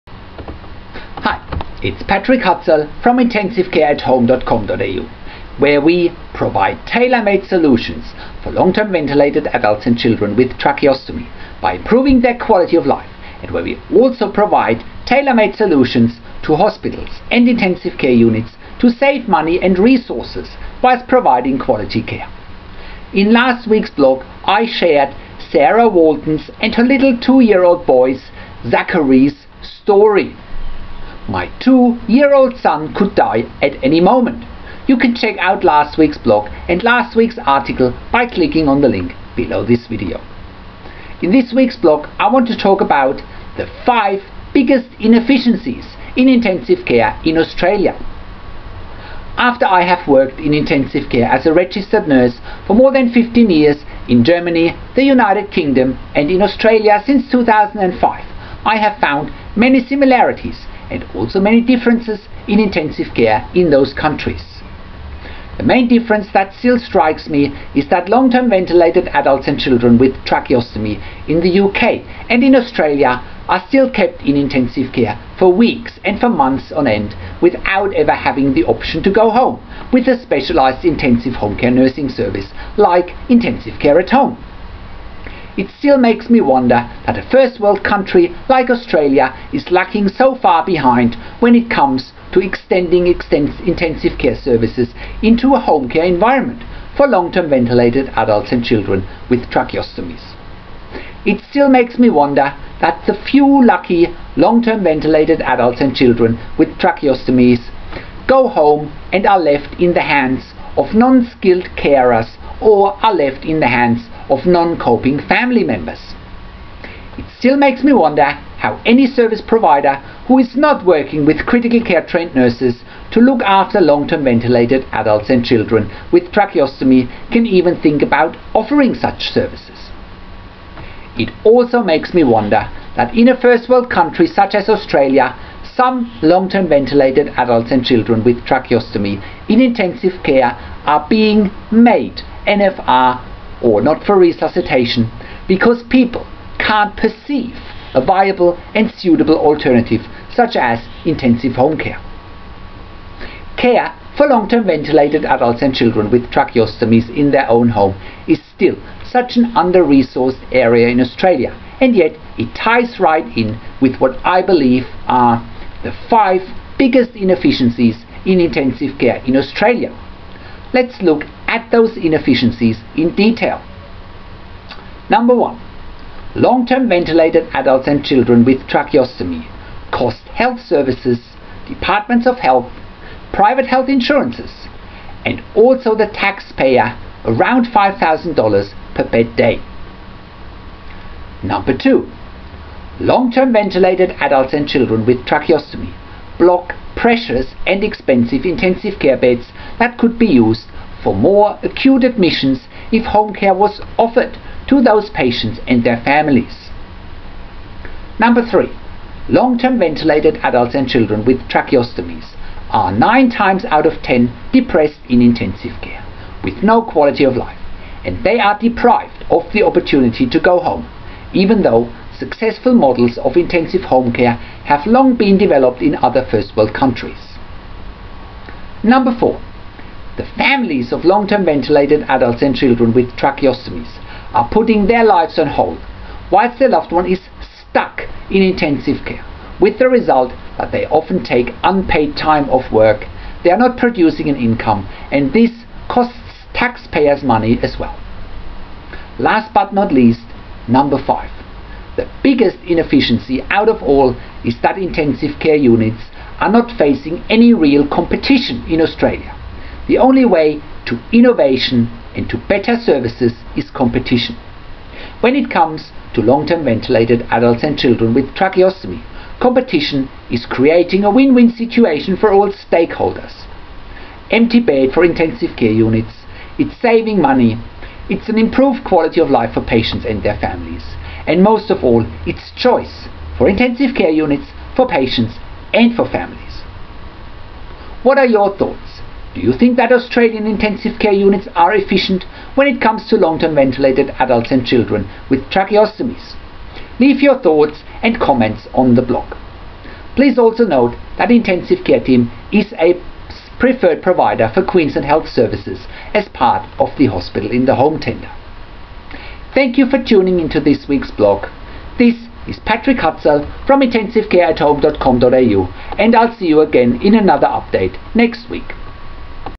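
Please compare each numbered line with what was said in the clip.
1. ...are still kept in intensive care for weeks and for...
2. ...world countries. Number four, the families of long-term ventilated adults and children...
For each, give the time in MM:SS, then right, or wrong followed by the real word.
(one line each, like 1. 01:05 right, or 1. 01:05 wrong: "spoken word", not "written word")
1. 01:13 right
2. 03:46 right.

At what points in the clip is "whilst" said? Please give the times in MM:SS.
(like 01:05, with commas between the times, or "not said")
00:20, 03:56.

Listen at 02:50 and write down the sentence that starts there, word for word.
Let's look at those inefficiencies in detail.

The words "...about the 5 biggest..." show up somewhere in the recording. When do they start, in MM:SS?
00:42.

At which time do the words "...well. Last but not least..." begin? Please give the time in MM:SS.
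04:07.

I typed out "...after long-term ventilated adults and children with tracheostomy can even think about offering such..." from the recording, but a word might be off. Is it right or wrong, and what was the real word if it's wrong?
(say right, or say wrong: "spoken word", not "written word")
right.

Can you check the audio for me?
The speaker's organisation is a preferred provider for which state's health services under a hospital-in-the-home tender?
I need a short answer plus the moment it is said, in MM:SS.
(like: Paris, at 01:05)
Queensland, at 05:04.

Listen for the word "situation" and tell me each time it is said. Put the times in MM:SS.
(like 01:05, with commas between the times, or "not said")
04:31.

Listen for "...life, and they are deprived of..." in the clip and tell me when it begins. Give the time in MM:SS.
03:37.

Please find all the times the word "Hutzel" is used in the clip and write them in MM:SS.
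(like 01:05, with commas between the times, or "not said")
00:02, 05:12.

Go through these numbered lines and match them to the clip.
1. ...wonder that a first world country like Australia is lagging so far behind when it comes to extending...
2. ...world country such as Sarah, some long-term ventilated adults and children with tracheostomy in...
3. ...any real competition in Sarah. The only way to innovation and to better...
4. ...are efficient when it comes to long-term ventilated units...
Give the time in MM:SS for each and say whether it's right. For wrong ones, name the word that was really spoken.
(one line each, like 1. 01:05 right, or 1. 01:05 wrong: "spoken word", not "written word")
1. 01:26 right
2. 02:13 wrong: "Australia", not "Sarah"
3. 04:17 wrong: "Australia", not "Sarah"
4. 04:51 wrong: "adults", not "units".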